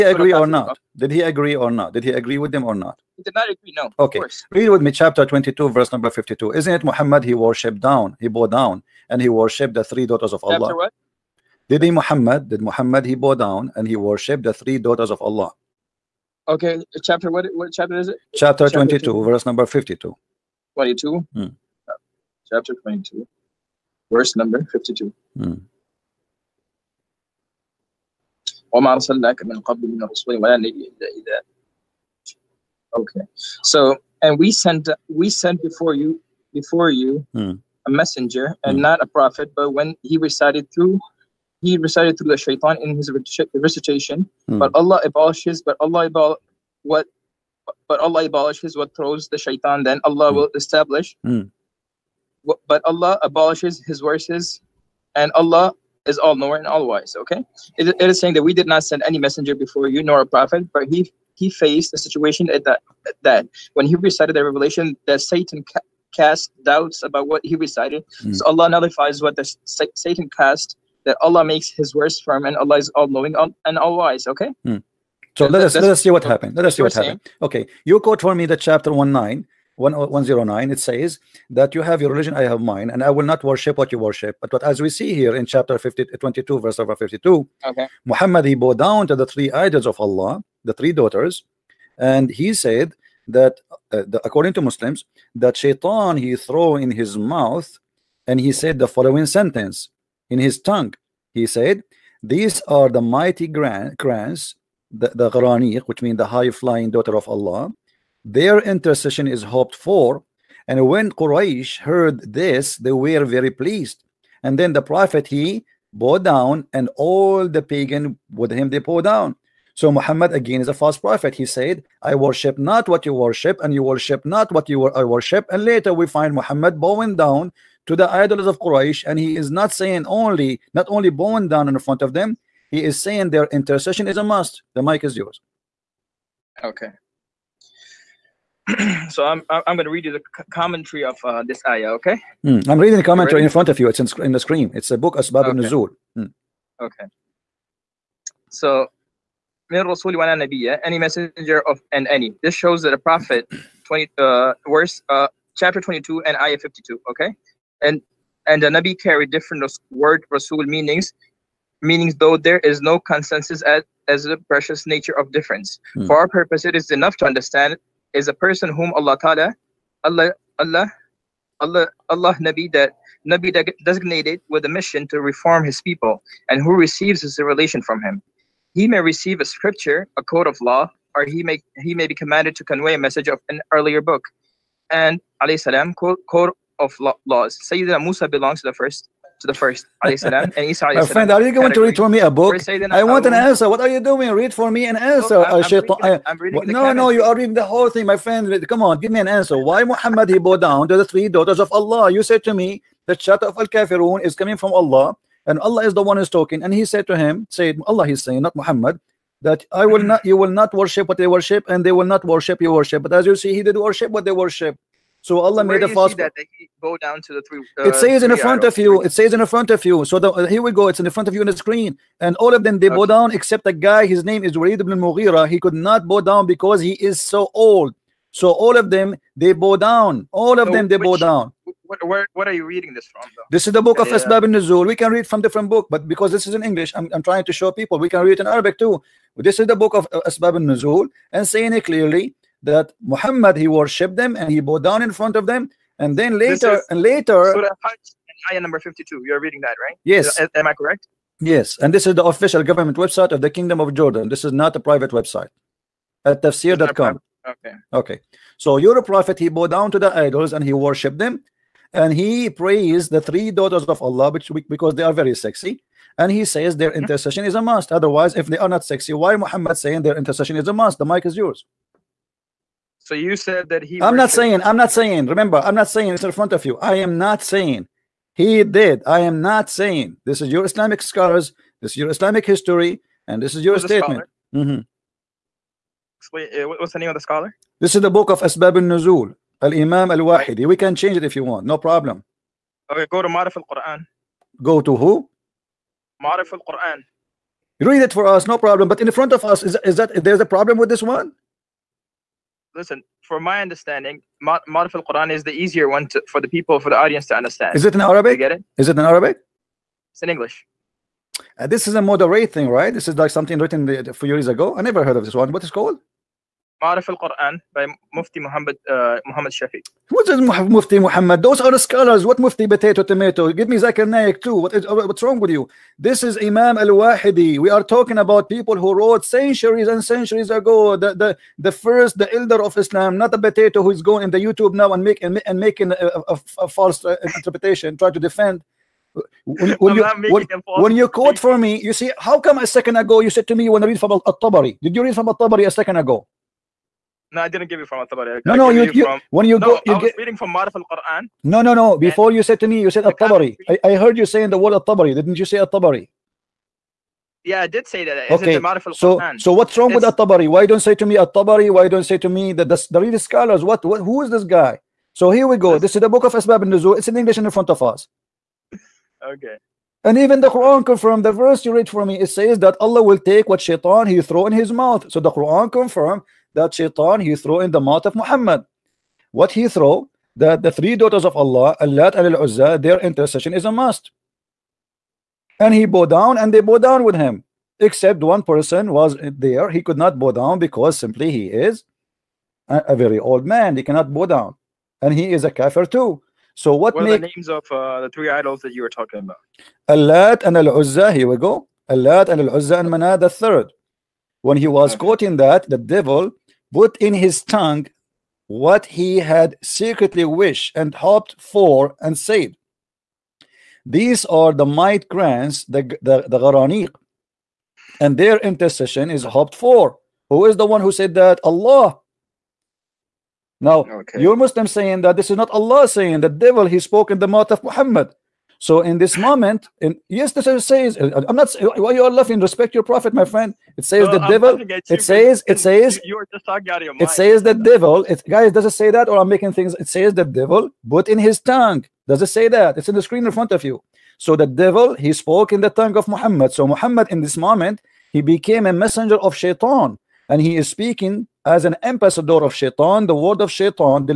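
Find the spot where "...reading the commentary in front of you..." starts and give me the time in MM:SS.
02:22.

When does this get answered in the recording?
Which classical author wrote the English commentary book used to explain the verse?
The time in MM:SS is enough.
04:49.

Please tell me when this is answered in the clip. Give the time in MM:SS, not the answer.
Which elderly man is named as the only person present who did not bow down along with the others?
03:44.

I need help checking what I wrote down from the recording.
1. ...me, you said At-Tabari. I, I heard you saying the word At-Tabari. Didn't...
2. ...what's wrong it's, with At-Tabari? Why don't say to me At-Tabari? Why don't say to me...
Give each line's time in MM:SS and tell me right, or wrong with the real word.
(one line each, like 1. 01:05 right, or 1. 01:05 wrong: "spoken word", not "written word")
1. 05:52 right
2. 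05:59 right.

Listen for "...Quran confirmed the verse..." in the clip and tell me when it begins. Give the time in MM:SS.
06:10.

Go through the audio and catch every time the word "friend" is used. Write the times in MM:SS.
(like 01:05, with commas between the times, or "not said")
03:11, 03:18, 07:13.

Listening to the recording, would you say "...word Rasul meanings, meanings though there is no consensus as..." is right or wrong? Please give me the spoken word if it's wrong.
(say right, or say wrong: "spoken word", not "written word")
right.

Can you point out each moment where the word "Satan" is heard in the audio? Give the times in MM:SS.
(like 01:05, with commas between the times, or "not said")
01:05, 01:09.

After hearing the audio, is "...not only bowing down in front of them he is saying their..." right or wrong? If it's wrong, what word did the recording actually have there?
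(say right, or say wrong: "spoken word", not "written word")
right.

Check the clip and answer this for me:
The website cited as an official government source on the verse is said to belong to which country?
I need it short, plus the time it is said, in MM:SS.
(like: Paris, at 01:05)
Jordan, at 04:13.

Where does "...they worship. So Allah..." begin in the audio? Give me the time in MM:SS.
03:34.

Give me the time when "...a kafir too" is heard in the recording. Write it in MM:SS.
06:35.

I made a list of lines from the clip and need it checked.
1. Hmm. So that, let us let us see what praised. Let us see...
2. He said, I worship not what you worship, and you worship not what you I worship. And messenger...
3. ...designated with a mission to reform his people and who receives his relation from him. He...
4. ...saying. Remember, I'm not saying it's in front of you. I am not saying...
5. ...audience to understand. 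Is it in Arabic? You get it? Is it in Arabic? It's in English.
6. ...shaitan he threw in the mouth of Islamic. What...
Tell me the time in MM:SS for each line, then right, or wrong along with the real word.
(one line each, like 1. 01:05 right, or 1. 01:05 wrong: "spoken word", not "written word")
1. 01:14 wrong: "happened", not "praised"
2. 02:01 wrong: "later", not "messenger"
3. 02:53 right
4. 04:34 right
5. 05:06 right
6. 06:16 wrong: "Muhammad", not "Islamic".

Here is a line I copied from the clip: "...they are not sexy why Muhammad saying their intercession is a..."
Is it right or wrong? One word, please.
right.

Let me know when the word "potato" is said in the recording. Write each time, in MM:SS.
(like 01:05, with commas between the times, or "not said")
05:22, 05:33.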